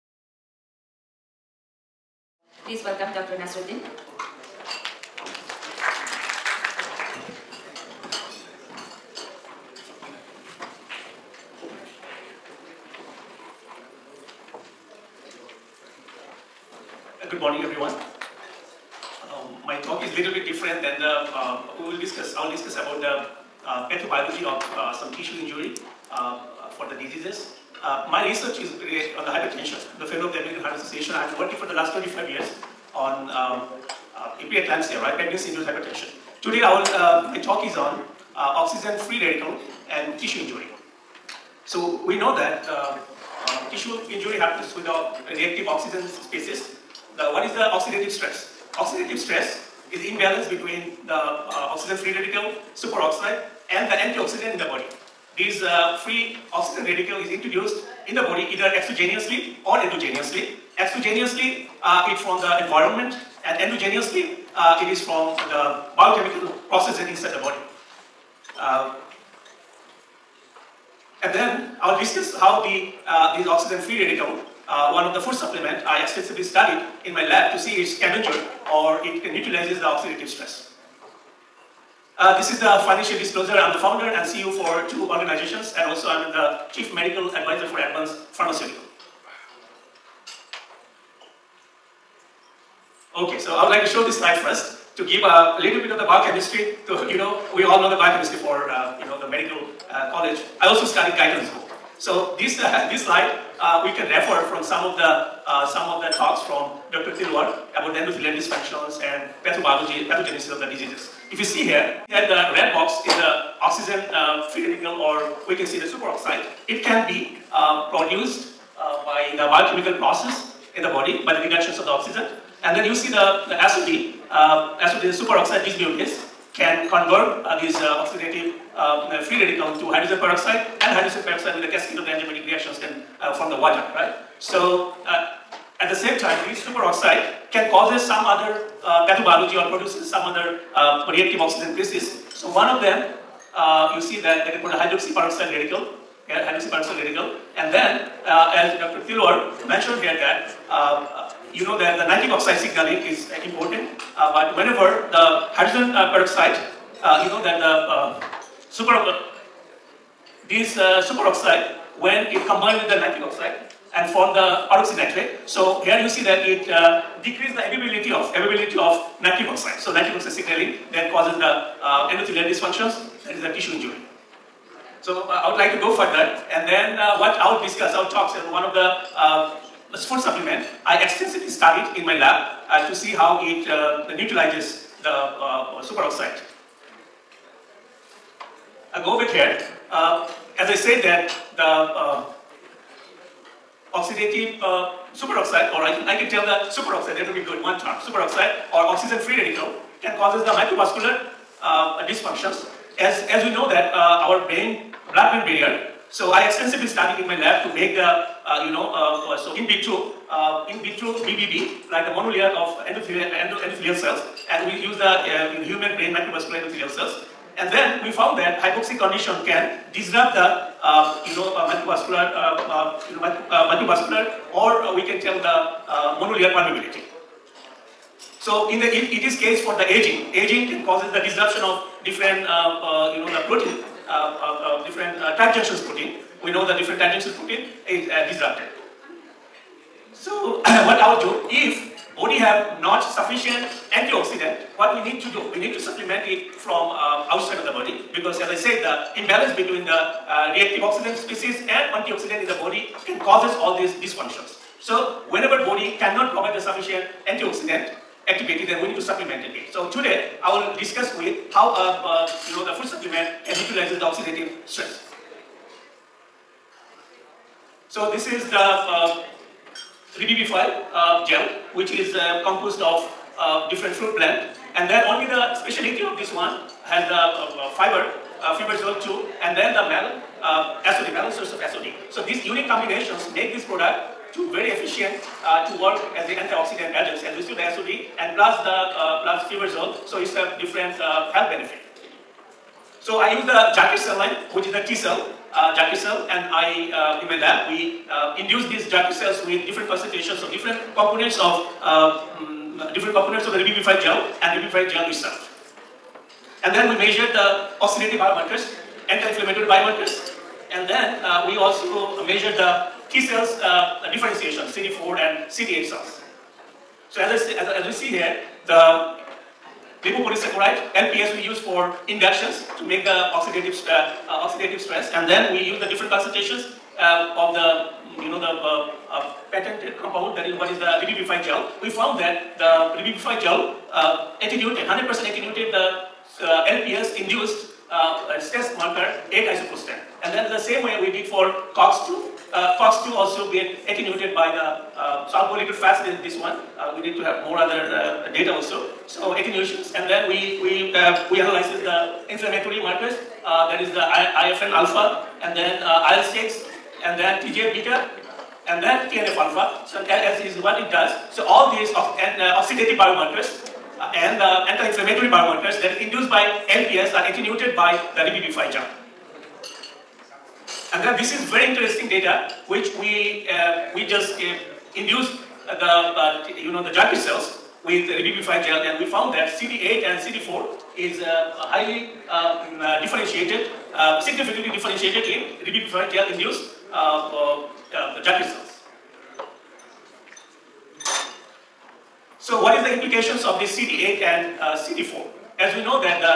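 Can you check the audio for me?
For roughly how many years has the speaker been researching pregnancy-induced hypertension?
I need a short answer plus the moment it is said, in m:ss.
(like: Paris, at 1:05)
25, at 0:31.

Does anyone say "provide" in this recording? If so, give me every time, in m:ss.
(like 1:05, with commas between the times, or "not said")
4:16.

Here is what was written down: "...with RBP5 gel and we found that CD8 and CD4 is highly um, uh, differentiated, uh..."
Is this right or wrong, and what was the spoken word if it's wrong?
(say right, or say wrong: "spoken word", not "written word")
right.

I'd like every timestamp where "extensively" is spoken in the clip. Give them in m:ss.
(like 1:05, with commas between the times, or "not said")
1:16, 3:01, 3:26.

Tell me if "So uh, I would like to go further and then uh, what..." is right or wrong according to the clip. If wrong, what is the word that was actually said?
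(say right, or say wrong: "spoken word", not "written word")
right.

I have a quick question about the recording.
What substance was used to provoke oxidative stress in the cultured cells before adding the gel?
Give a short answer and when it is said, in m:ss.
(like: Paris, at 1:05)
lipopolysaccharide, at 5:20.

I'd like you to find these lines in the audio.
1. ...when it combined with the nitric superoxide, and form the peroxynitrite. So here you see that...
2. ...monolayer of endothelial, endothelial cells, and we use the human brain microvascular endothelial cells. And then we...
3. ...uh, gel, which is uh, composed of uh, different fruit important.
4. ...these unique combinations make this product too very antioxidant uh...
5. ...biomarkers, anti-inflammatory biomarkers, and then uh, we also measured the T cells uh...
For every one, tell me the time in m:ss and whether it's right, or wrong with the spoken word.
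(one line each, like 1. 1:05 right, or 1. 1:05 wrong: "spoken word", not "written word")
1. 2:42 wrong: "oxide", not "superoxide"
2. 3:32 right
3. 4:30 wrong: "plant", not "important"
4. 4:42 wrong: "efficient", not "antioxidant"
5. 5:08 right.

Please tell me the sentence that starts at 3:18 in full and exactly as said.
Superoxide or oxygen-free radical can causes the microvascular uh, dysfunctions.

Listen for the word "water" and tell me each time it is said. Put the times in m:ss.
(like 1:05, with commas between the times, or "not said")
2:13.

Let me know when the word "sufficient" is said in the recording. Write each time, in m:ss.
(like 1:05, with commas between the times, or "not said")
4:03, 4:16.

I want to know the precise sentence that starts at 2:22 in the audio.
So one of them, you see that they can called hydroxy peroxide radical okay, peroxide radical.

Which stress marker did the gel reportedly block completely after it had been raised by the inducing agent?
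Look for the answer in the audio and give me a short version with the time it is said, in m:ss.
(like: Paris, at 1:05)
8 isoprostane, at 5:39.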